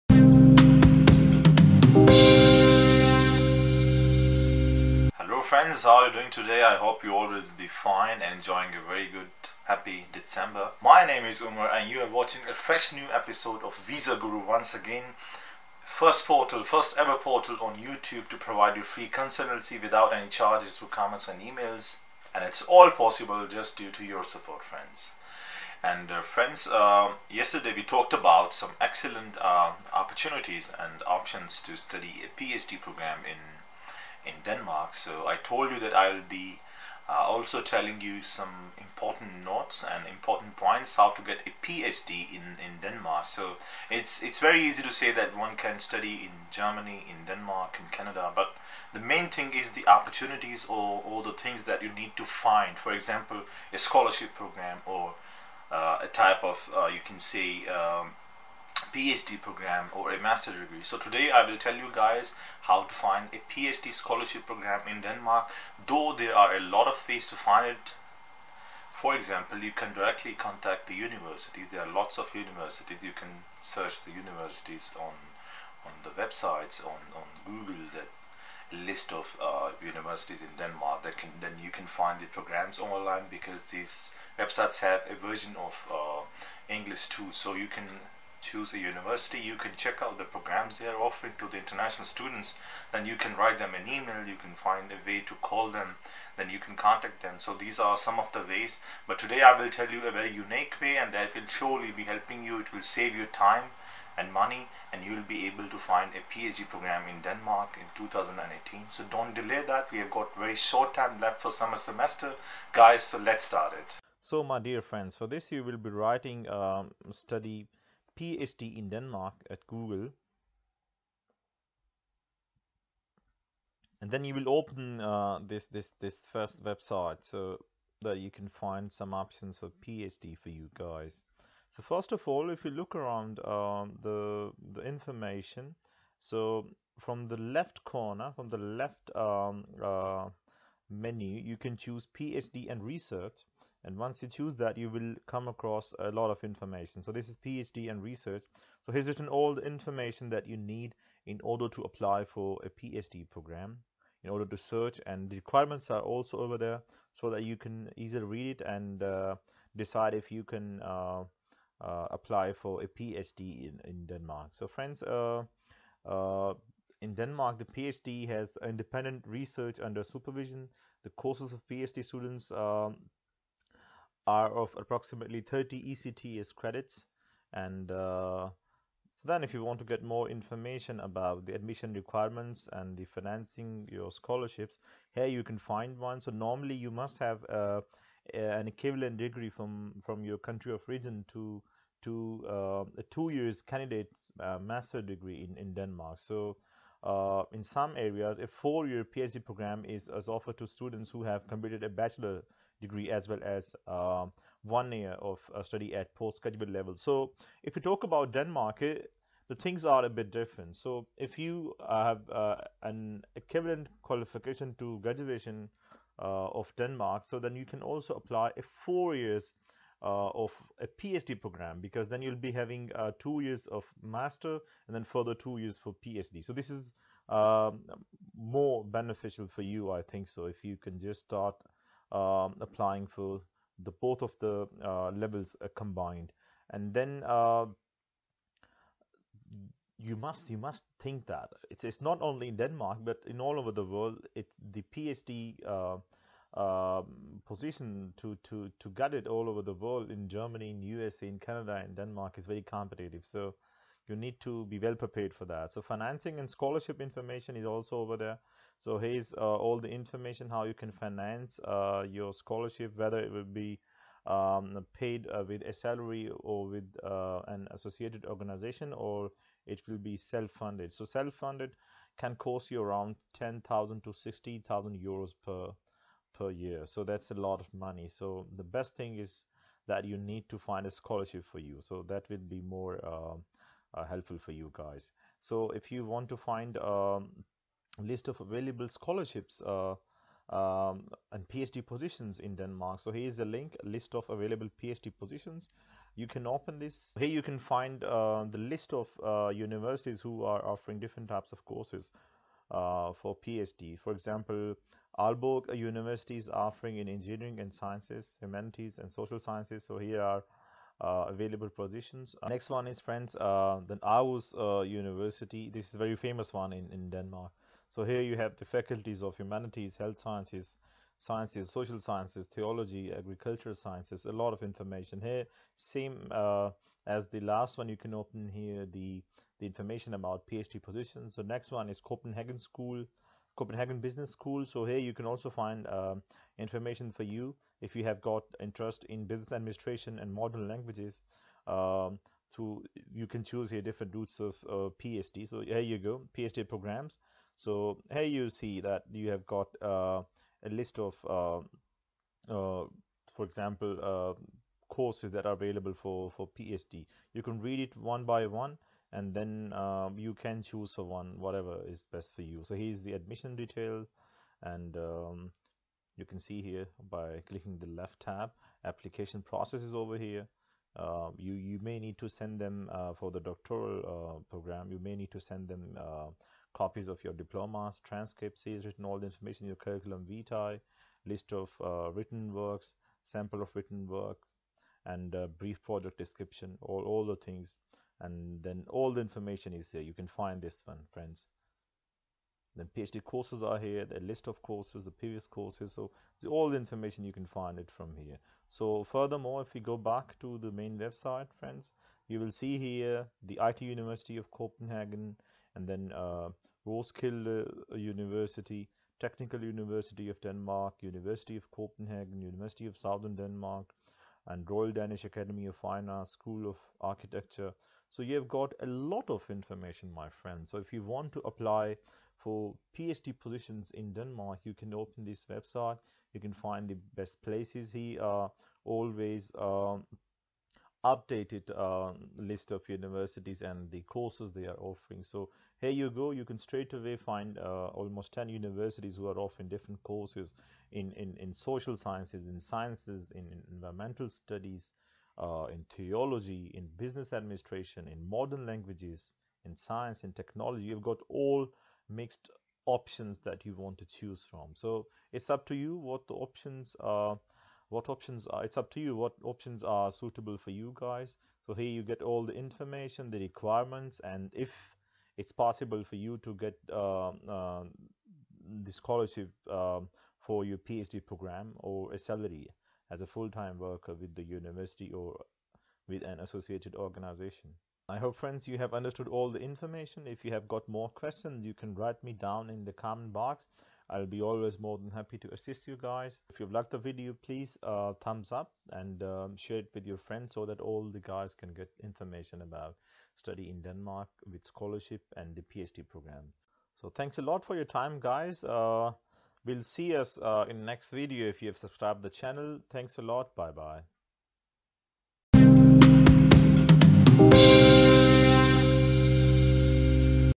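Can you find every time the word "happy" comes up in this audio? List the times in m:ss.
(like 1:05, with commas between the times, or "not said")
0:09, 8:05.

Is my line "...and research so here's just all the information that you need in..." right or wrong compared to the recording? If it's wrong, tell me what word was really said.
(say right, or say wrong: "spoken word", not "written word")
right.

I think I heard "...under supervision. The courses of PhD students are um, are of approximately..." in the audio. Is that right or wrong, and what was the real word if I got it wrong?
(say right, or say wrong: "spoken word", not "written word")
right.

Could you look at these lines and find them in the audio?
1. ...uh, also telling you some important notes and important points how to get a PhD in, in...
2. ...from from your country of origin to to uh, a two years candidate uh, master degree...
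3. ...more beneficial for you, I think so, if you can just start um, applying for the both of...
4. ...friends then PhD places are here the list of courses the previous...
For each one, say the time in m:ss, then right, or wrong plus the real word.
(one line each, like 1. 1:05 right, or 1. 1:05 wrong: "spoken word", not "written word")
1. 0:37 right
2. 3:09 right
3. 3:48 right
4. 6:31 wrong: "courses", not "places".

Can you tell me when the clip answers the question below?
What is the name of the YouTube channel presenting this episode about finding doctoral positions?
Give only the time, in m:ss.
0:13.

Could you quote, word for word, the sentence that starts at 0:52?
For example, a scholarship program or uh, a type of, uh, you can say, um, PhD program or a master's degree.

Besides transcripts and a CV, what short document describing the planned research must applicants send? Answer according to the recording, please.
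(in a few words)
brief project description.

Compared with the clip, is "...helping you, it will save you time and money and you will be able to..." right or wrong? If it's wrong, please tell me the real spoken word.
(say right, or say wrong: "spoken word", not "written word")
right.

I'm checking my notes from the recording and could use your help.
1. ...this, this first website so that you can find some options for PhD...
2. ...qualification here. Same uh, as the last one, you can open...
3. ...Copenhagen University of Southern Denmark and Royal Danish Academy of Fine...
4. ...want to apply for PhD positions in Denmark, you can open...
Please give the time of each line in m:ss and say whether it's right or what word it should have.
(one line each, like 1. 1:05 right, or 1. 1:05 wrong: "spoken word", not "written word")
1. 2:05 right
2. 5:24 wrong: "information", not "qualification"
3. 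6:51 right
4. 7:01 right.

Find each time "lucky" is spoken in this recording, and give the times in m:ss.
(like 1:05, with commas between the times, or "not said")
not said.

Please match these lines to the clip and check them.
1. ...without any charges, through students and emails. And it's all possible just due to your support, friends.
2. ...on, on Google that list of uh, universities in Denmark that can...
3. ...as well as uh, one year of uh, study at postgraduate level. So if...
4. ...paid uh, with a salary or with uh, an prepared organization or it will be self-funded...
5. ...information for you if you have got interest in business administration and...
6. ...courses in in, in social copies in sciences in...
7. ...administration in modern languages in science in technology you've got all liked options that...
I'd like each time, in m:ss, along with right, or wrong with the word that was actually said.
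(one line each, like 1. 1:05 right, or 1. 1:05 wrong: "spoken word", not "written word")
1. 0:19 wrong: "comments", not "students"
2. 1:16 right
3. 3:23 right
4. 4:24 wrong: "associated", not "prepared"
5. 5:36 right
6. 7:20 wrong: "sciences", not "copies"
7. 7:27 wrong: "mixed", not "liked".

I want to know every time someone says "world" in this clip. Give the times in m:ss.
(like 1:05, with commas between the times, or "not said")
4:03, 4:09.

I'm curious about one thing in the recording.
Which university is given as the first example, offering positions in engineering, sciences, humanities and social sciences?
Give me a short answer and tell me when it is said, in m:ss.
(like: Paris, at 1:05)
Aalborg University, at 5:05.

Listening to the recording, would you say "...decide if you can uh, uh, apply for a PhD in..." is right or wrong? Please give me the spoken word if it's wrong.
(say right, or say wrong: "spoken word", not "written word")
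right.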